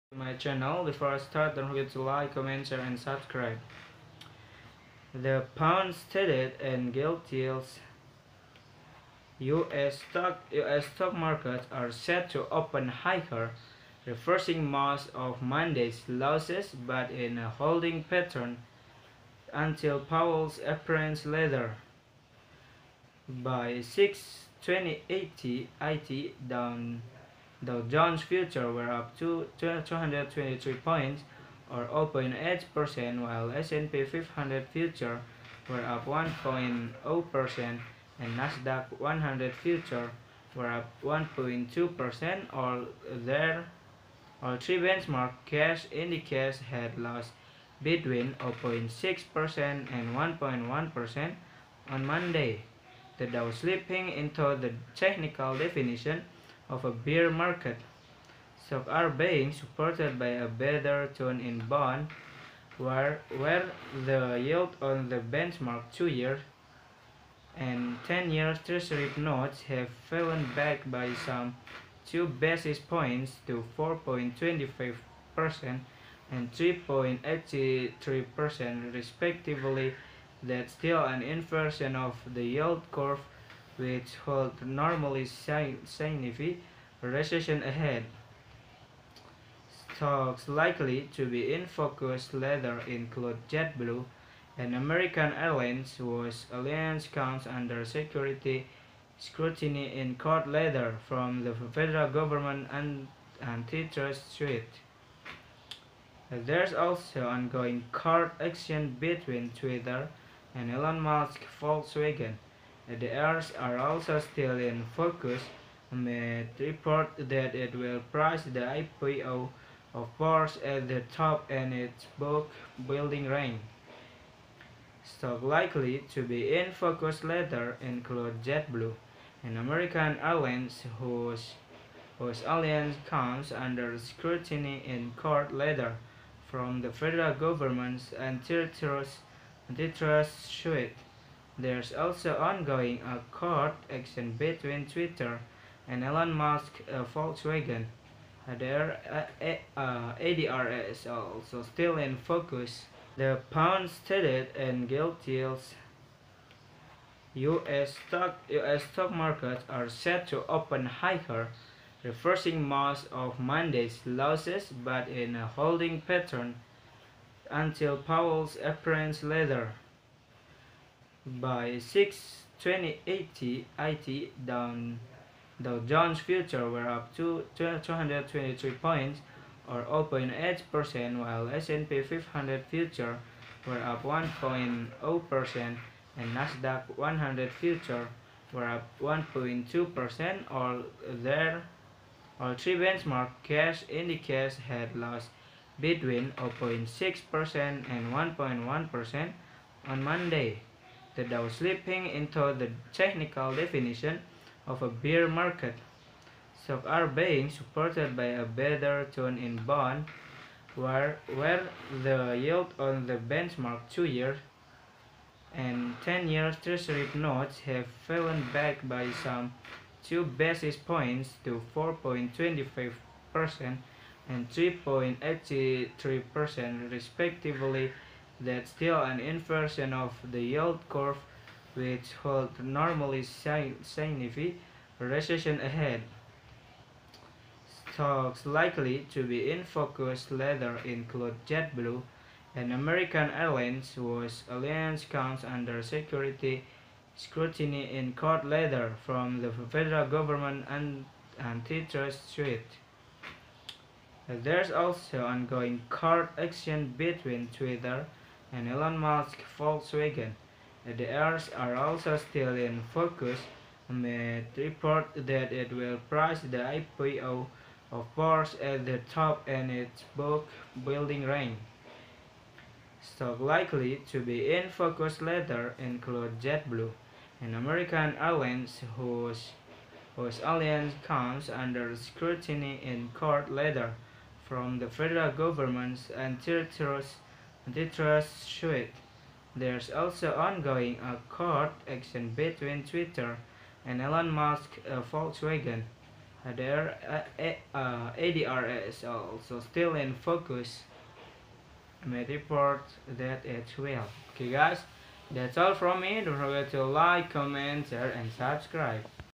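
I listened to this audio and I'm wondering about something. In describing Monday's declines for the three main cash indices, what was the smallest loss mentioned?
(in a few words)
0.6%.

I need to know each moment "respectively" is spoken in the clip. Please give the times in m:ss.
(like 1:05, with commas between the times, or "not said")
1:18, 3:46.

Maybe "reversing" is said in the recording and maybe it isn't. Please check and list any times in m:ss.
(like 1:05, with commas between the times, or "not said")
0:14, 2:42.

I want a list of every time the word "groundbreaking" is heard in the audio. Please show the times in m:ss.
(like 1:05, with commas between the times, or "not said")
not said.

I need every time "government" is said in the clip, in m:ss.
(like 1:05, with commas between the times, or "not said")
1:42, 2:17, 4:10, 4:45.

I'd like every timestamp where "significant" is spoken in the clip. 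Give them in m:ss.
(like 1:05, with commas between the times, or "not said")
1:25, 3:53.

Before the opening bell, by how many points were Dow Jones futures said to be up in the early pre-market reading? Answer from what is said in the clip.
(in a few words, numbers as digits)
223.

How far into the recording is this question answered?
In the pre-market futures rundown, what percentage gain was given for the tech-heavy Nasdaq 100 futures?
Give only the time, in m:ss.
0:41.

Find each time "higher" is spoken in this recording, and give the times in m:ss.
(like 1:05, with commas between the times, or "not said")
0:12, 2:40.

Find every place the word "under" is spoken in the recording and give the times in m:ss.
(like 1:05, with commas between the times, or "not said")
1:37, 2:13, 4:05, 4:41.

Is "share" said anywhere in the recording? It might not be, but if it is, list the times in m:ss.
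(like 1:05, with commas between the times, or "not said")
0:02, 5:07.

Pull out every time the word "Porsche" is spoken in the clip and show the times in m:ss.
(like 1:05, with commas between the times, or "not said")
2:00, 4:28.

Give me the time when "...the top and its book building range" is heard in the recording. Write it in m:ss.
2:00.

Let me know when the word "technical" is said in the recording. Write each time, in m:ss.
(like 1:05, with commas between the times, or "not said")
0:54, 3:22.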